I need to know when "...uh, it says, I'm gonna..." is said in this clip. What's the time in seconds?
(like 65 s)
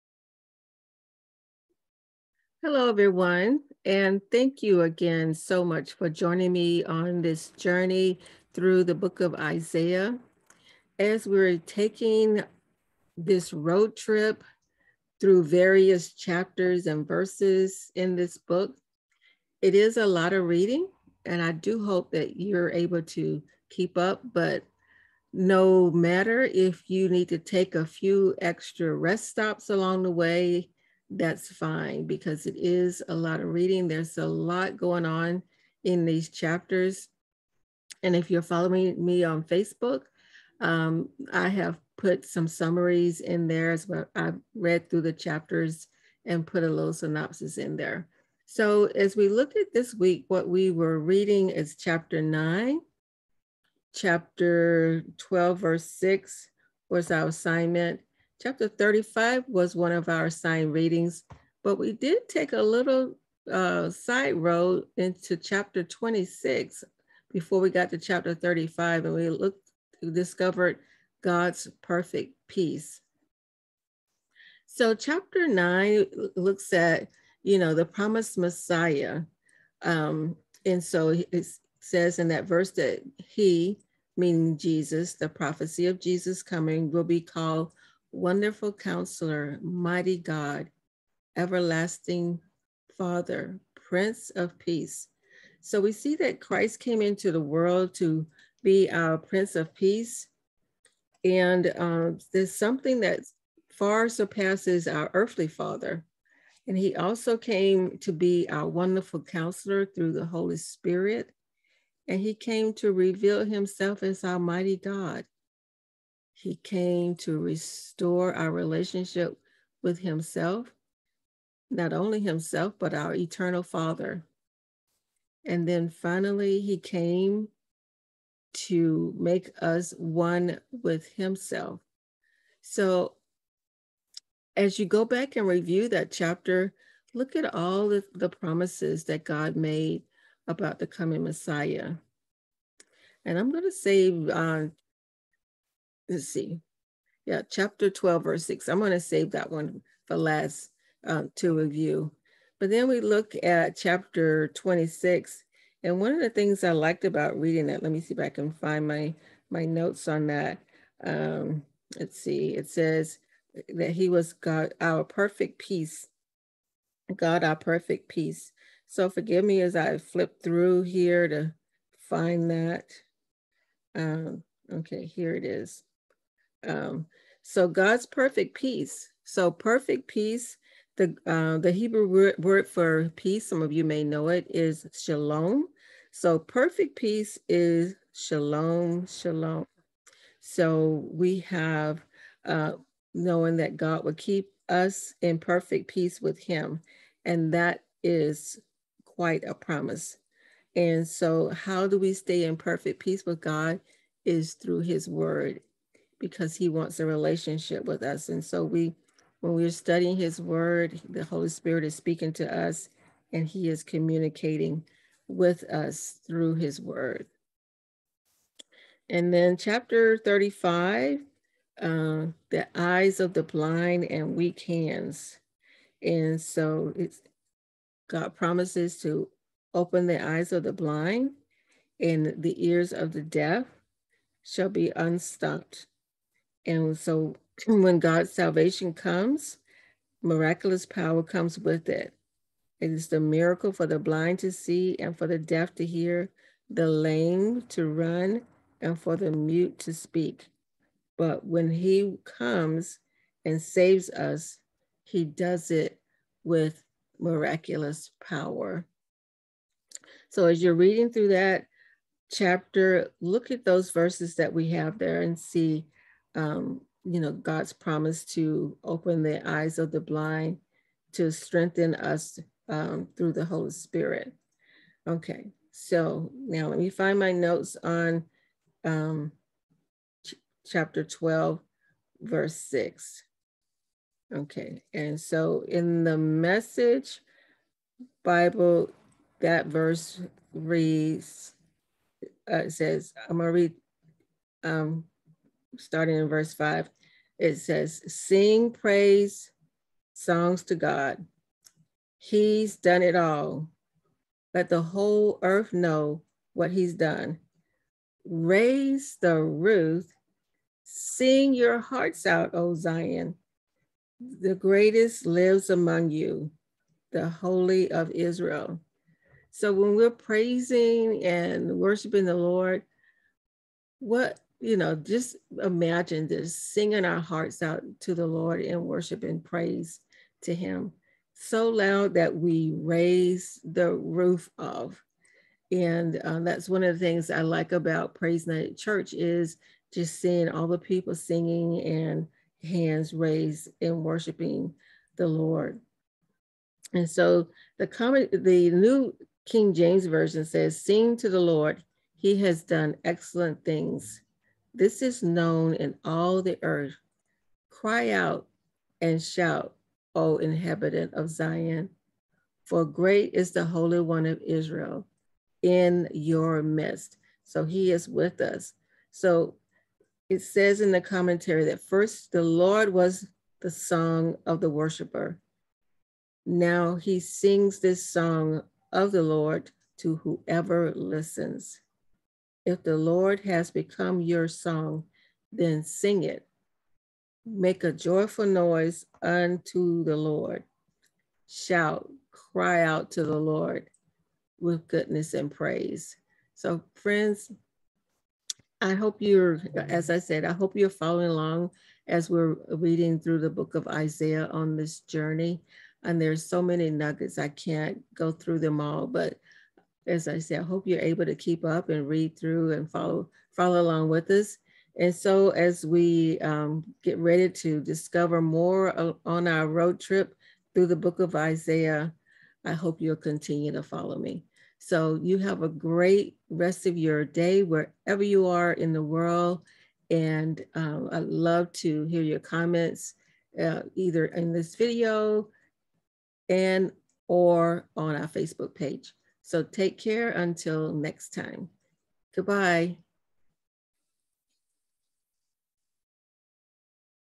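292 s.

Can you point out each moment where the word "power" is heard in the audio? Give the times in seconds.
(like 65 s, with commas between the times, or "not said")
240 s, 258 s.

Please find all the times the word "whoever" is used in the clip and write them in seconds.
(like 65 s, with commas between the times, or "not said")
380 s.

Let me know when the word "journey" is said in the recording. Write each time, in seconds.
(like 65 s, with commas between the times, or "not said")
7 s, 405 s.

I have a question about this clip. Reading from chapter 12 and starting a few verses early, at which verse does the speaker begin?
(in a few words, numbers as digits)
5.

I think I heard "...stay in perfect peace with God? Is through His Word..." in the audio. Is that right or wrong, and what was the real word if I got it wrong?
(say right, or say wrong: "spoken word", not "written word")
right.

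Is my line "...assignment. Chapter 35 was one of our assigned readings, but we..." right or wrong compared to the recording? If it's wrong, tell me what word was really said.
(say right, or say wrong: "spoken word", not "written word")
right.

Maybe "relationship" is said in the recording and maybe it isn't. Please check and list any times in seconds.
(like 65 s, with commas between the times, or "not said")
118 s, 207 s.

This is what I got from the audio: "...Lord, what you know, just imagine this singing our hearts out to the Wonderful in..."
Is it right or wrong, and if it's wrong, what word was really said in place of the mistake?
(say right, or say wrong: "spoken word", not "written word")
wrong: "Lord", not "Wonderful".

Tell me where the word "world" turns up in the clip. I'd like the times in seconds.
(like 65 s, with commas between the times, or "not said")
97 s, 429 s.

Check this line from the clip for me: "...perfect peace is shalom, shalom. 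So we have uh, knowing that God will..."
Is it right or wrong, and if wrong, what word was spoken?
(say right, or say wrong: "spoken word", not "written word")
right.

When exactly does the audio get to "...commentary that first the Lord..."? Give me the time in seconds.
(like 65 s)
371 s.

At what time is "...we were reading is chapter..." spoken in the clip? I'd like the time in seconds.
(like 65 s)
50 s.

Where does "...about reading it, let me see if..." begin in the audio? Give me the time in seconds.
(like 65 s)
157 s.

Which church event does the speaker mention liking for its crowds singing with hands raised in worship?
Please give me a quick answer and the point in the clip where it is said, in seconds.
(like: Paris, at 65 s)
Praise Night Church, at 338 s.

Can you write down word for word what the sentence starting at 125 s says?
And then finally, He came to make us one with Himself.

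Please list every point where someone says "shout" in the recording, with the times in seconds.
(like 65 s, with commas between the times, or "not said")
359 s, 391 s.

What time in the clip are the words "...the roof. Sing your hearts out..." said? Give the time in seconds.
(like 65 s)
309 s.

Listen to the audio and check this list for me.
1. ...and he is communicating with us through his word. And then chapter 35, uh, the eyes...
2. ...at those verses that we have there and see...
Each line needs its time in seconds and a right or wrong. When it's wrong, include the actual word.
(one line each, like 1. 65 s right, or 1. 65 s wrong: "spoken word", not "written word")
1. 213 s right
2. 263 s right.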